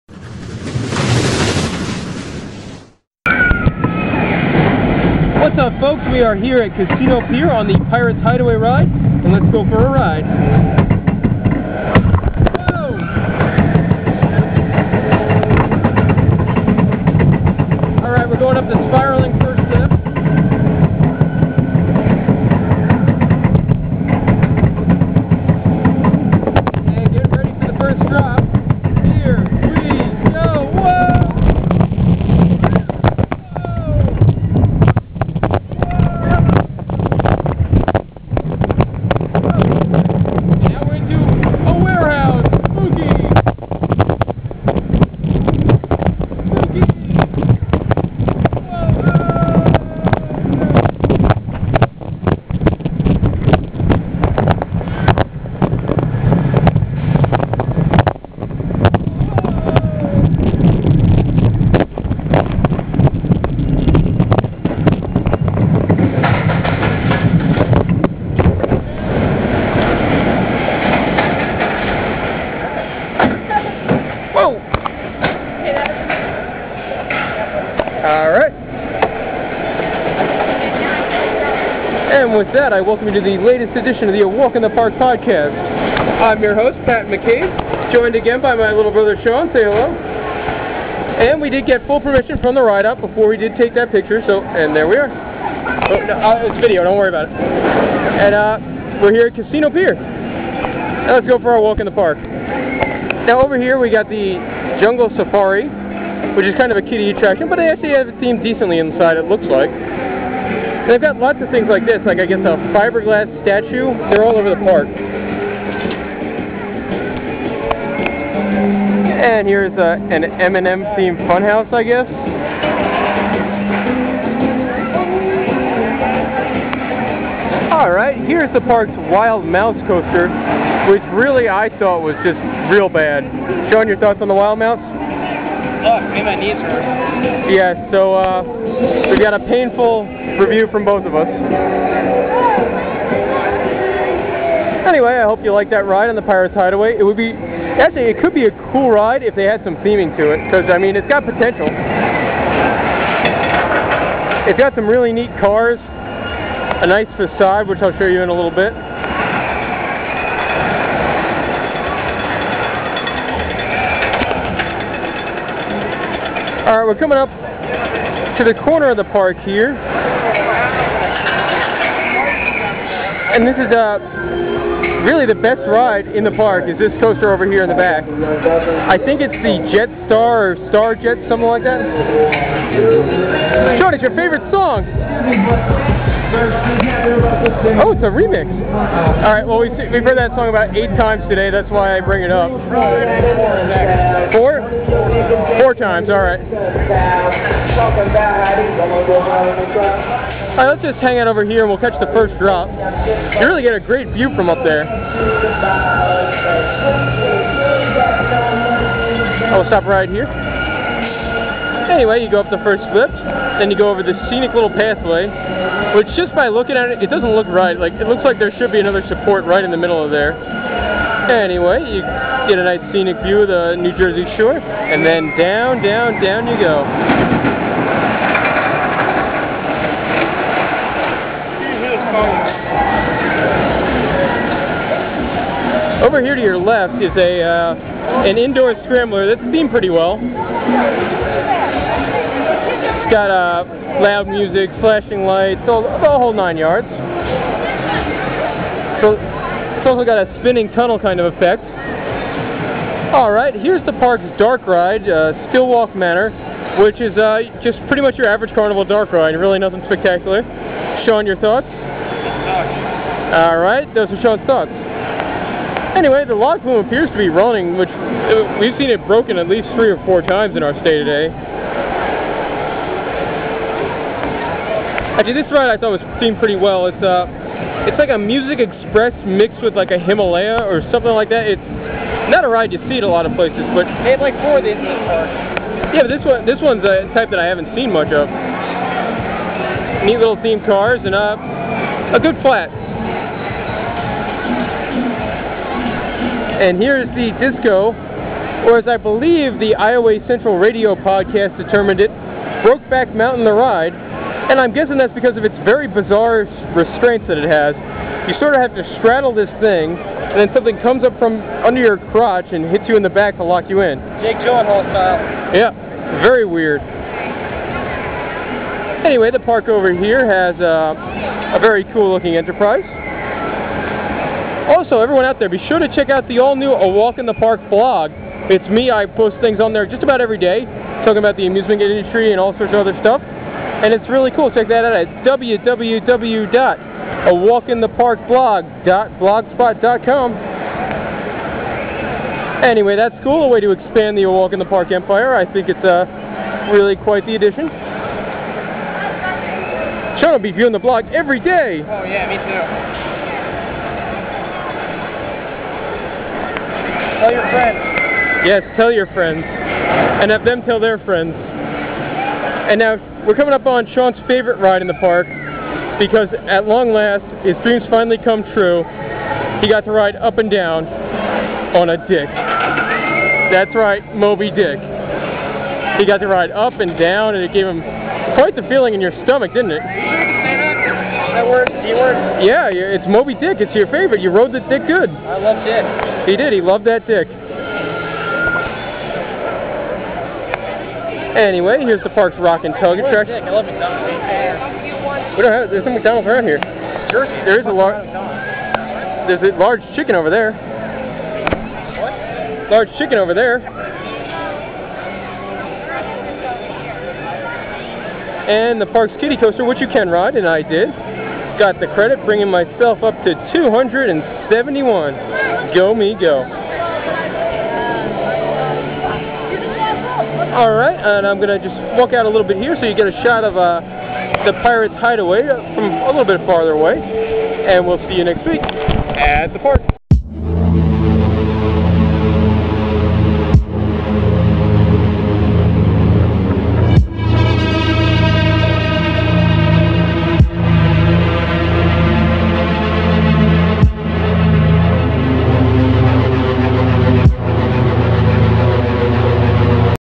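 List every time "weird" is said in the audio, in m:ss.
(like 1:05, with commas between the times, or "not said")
5:16.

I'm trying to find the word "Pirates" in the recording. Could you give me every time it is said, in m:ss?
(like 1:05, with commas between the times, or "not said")
0:07, 2:26, 7:04.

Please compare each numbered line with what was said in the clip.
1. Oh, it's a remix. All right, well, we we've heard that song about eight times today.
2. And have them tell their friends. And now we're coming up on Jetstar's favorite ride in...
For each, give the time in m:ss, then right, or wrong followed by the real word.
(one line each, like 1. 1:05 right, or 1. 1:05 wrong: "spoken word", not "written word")
1. 3:07 right
2. 5:59 wrong: "Sean", not "Jetstar".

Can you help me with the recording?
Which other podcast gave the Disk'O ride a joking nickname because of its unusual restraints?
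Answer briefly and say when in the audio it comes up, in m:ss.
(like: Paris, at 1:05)
Iowa Central Radio, at 4:59.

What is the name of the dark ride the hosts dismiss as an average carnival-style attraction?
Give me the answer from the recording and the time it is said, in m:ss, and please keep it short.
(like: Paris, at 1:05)
Stillwalk Manor, at 4:15.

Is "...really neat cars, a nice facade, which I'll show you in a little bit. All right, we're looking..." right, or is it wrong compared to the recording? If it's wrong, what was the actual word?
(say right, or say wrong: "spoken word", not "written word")
wrong: "coming", not "looking".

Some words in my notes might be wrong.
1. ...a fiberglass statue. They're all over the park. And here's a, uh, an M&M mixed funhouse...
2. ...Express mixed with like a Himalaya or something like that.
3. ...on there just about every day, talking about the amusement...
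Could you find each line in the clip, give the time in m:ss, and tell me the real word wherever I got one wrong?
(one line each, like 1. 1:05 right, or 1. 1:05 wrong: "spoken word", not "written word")
1. 1:52 wrong: "themed", not "mixed"
2. 4:38 right
3. 5:29 right.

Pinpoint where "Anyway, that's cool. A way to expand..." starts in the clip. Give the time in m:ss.
5:42.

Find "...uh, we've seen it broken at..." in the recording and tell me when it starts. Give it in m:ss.
4:27.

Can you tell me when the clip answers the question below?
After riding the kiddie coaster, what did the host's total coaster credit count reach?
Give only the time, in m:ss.
6:53.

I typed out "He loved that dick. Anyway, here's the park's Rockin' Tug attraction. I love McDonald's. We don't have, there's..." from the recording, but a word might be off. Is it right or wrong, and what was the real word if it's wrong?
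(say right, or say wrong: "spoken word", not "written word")
right.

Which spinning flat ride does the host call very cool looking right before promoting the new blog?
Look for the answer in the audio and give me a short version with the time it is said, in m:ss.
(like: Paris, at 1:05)
Enterprise, at 5:22.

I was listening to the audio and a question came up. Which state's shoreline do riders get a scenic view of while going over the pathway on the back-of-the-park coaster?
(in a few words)
New Jersey.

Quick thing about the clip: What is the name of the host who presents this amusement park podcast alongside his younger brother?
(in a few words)
Pat McCabe.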